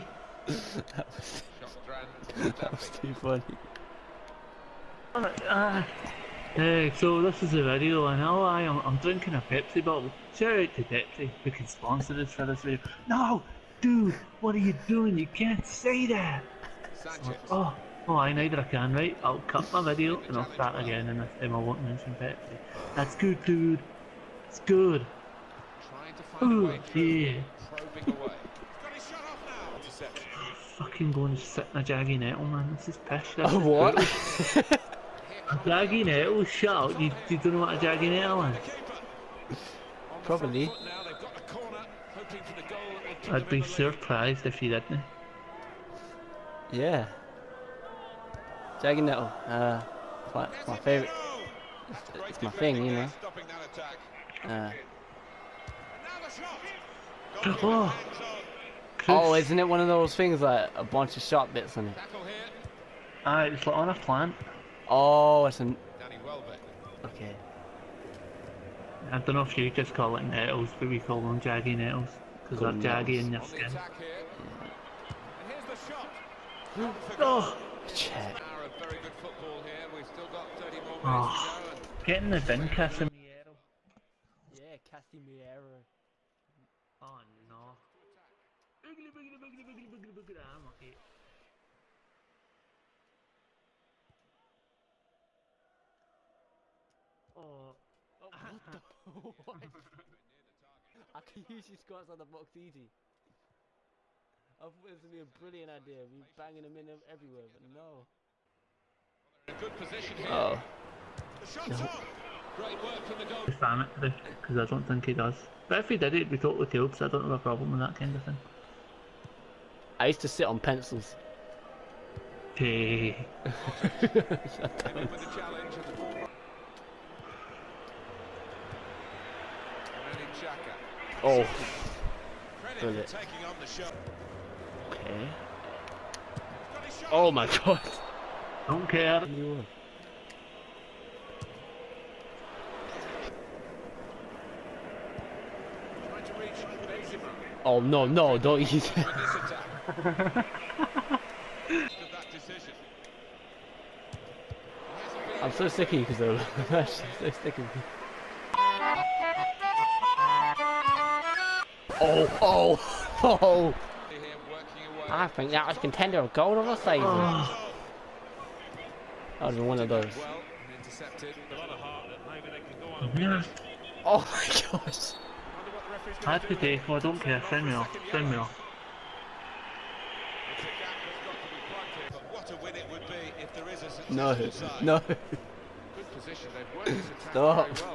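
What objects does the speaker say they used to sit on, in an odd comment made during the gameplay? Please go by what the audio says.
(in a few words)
pencils.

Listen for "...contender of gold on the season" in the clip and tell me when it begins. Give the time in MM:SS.
02:45.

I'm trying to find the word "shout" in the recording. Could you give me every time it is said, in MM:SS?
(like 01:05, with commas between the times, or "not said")
00:10, 00:36.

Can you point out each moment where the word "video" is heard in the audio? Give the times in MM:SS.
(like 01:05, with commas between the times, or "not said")
00:07, 00:12, 00:19.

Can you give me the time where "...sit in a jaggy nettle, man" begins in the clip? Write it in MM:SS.
00:31.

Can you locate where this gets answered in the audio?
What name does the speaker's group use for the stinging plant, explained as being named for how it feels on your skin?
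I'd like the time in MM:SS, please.
01:11.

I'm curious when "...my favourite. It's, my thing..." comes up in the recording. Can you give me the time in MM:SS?
00:50.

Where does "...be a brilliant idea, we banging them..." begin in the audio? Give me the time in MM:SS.
01:45.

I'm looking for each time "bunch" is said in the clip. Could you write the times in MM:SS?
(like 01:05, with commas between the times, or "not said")
01:00.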